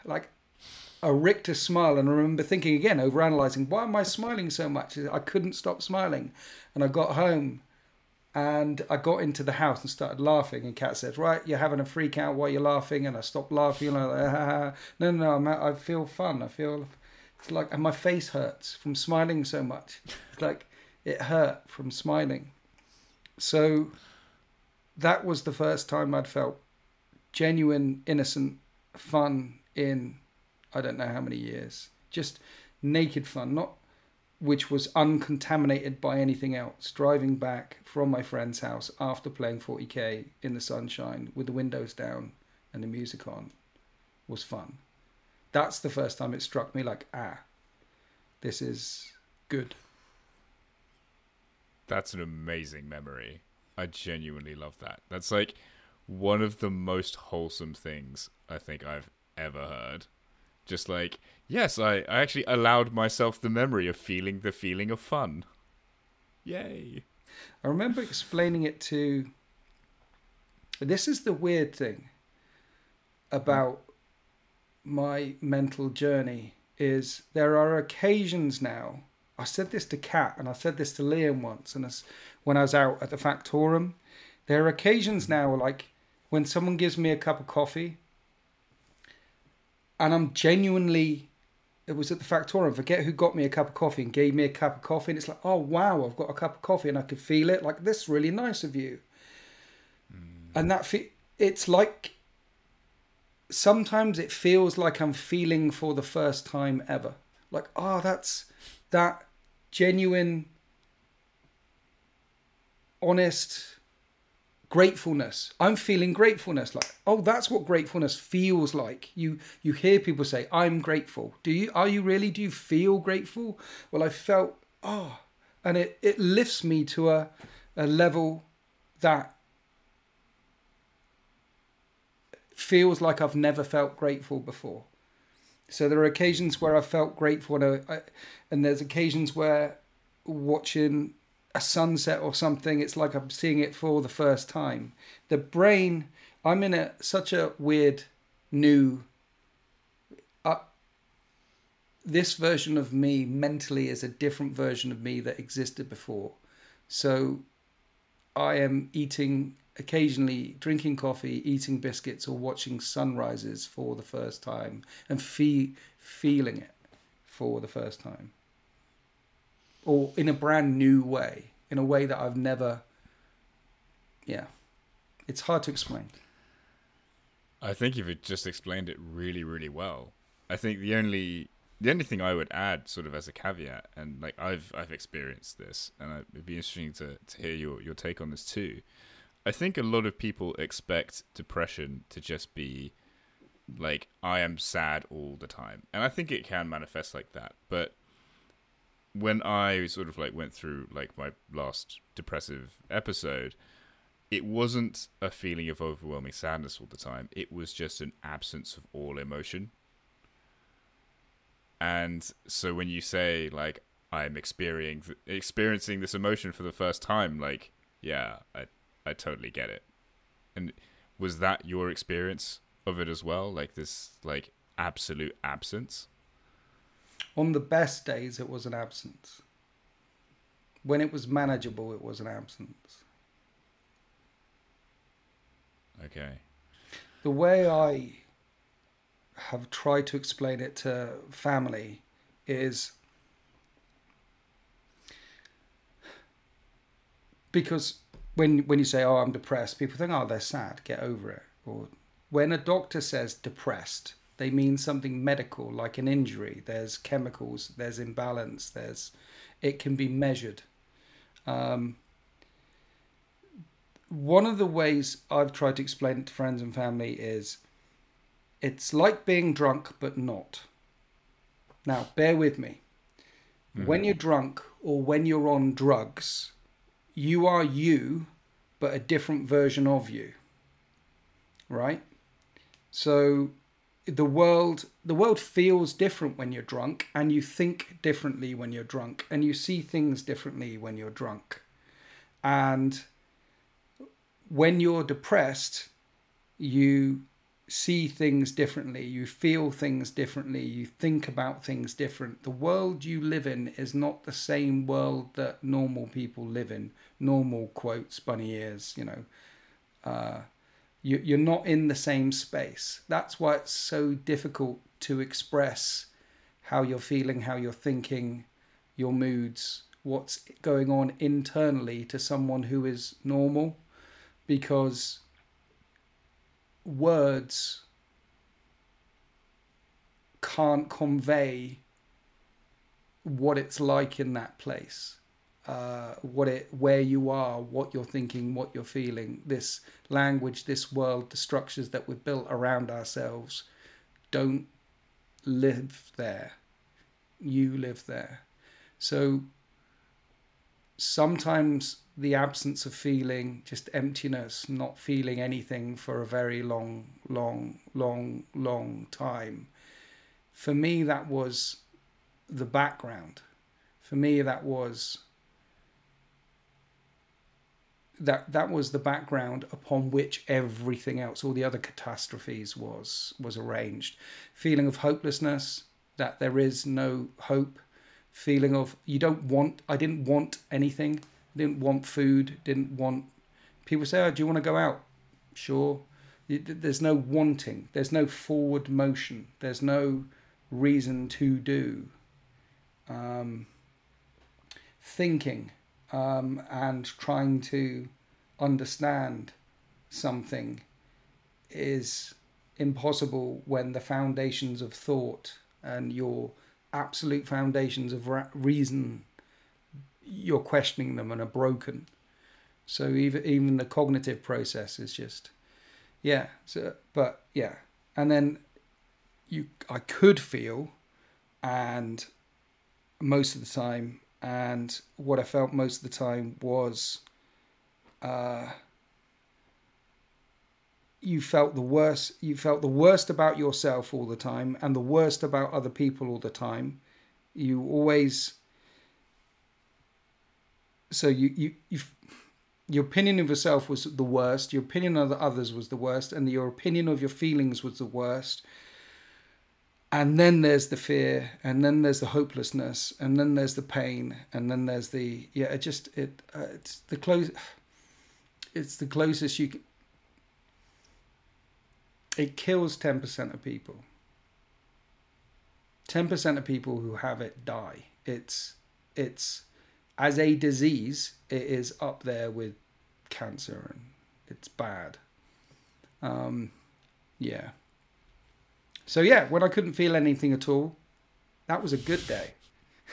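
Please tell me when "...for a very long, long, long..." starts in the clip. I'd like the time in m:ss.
5:55.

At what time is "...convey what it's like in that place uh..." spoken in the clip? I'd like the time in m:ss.
5:30.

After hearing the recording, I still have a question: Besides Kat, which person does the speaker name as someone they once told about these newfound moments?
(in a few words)
Liam.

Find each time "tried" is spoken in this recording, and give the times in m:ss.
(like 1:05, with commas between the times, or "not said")
3:59, 4:25.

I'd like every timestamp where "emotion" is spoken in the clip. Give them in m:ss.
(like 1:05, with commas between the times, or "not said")
3:29, 3:36.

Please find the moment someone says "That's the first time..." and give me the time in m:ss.
0:45.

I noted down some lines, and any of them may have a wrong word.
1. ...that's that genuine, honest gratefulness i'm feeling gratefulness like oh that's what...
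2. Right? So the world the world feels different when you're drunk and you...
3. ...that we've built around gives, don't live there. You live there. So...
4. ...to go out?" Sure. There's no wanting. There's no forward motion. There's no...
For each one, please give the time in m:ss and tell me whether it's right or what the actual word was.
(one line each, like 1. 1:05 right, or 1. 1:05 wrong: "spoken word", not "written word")
1. 1:47 right
2. 4:41 right
3. 5:41 wrong: "ourselves", not "gives"
4. 6:24 right.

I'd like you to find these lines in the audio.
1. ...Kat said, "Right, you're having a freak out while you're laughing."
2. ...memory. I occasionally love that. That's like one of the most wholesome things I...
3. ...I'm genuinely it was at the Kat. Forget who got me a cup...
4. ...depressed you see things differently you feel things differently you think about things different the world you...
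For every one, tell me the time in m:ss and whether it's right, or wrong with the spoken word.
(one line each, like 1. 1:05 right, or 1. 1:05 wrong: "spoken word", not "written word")
1. 0:10 right
2. 0:52 wrong: "genuinely", not "occasionally"
3. 1:30 wrong: "Factorum", not "Kat"
4. 4:55 right.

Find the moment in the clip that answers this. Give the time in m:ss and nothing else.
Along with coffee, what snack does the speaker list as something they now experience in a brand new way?
2:41.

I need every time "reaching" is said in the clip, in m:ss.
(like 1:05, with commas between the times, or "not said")
not said.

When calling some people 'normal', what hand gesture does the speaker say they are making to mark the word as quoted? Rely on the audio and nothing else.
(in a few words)
Bunny ears.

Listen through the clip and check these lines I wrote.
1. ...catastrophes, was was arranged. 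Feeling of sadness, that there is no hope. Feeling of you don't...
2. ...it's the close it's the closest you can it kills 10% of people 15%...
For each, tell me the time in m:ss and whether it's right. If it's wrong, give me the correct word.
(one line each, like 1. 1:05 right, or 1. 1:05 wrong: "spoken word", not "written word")
1. 6:11 wrong: "hopelessness", not "sadness"
2. 7:36 wrong: "10", not "15".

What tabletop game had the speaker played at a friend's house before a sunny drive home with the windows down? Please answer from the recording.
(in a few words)
40k.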